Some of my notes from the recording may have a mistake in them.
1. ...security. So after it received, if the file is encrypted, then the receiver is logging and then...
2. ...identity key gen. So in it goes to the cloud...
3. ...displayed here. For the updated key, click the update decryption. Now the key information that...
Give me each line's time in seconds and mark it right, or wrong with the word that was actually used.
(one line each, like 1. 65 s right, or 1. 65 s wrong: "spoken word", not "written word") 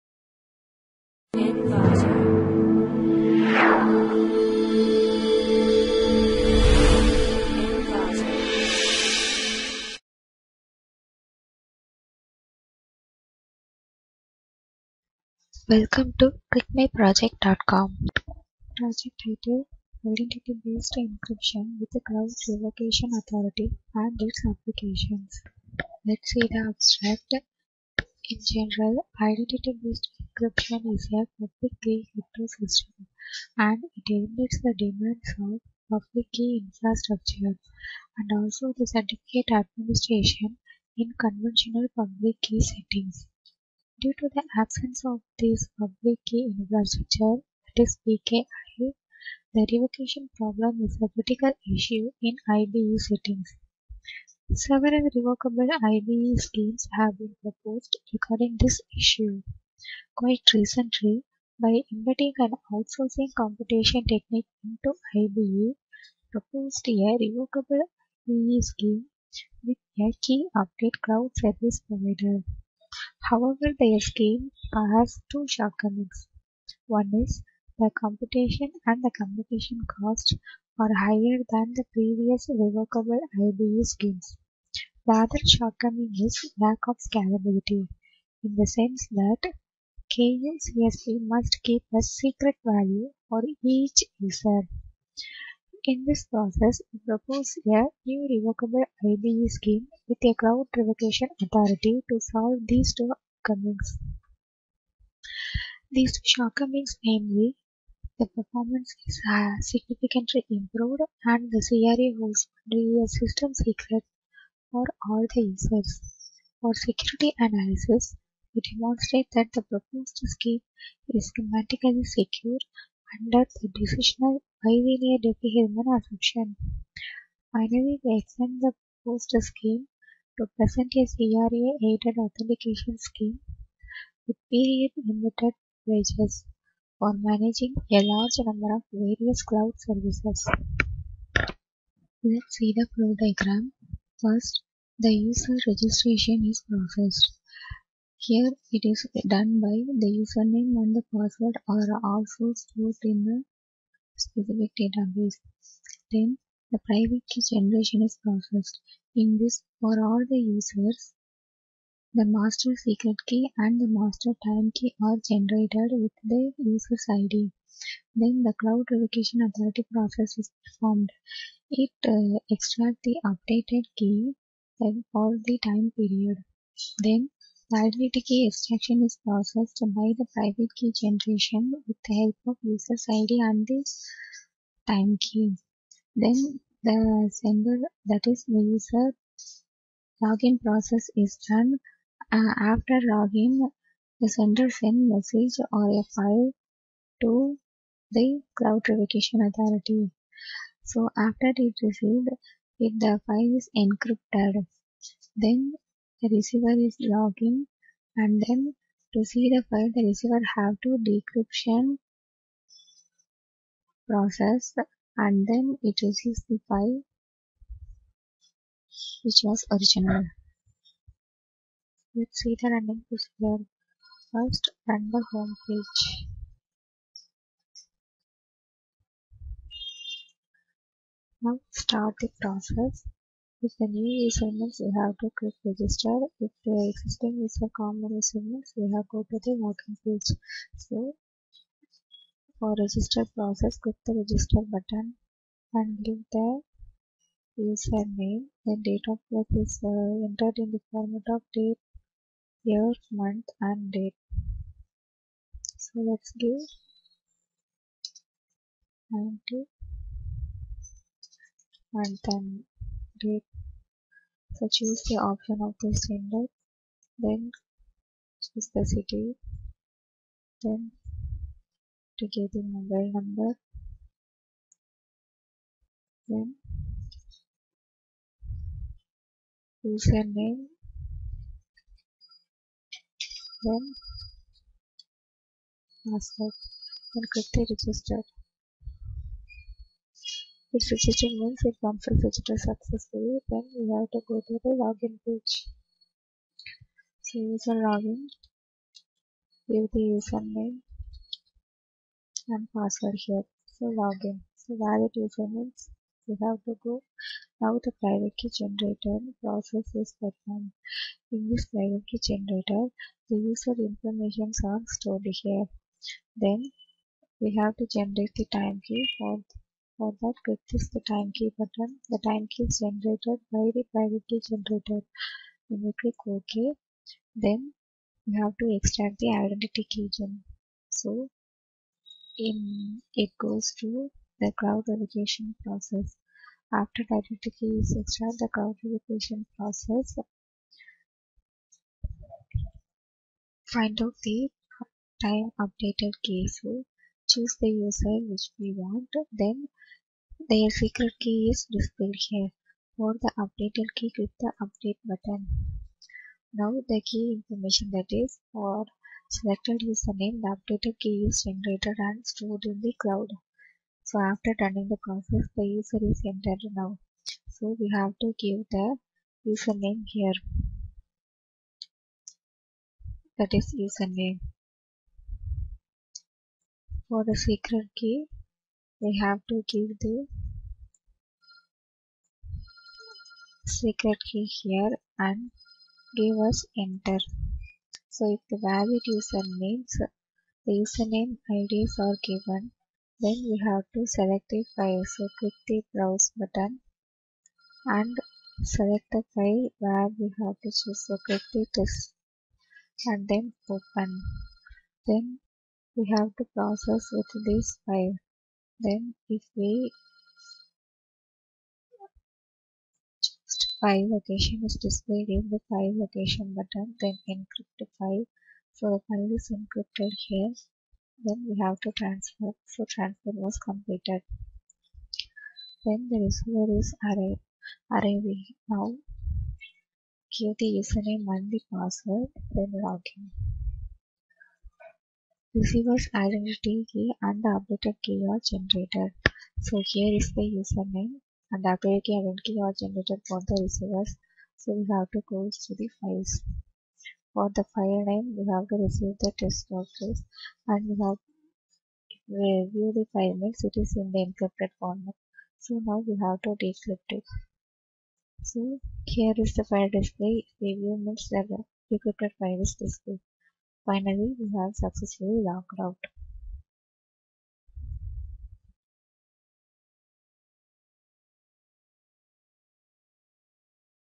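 1. 199 s wrong: "authority", not "security"
2. 329 s right
3. 351 s wrong: "button", not "decryption".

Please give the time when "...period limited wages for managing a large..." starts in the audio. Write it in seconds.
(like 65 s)
134 s.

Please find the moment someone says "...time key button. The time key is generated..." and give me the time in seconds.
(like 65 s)
321 s.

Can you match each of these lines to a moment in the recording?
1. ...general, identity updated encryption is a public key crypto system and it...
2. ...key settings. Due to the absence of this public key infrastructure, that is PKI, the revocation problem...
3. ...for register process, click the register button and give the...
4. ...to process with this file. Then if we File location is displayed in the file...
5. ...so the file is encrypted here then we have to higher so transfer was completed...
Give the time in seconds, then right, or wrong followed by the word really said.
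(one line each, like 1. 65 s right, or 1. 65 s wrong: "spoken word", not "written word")
1. 28 s wrong: "based", not "updated"
2. 42 s right
3. 242 s right
4. 406 s right
5. 418 s wrong: "transfer", not "higher".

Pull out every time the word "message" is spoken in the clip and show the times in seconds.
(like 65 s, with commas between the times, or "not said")
195 s.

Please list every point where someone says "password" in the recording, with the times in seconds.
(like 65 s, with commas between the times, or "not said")
151 s, 286 s, 302 s, 431 s.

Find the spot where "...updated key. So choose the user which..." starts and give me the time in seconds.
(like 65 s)
345 s.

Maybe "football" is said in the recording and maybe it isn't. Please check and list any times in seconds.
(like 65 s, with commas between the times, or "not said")
not said.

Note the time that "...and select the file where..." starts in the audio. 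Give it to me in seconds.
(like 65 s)
397 s.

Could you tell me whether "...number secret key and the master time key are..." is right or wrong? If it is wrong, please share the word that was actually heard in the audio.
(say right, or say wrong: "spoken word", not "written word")
wrong: "master", not "number".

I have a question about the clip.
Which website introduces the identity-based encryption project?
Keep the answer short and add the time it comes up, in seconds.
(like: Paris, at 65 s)
clickmyproject.com, at 16 s.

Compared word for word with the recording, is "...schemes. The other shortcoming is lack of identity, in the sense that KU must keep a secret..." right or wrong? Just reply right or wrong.
wrong.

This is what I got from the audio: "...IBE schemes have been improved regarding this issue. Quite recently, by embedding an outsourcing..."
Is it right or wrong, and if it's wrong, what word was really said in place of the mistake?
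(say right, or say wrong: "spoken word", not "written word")
wrong: "proposed", not "improved".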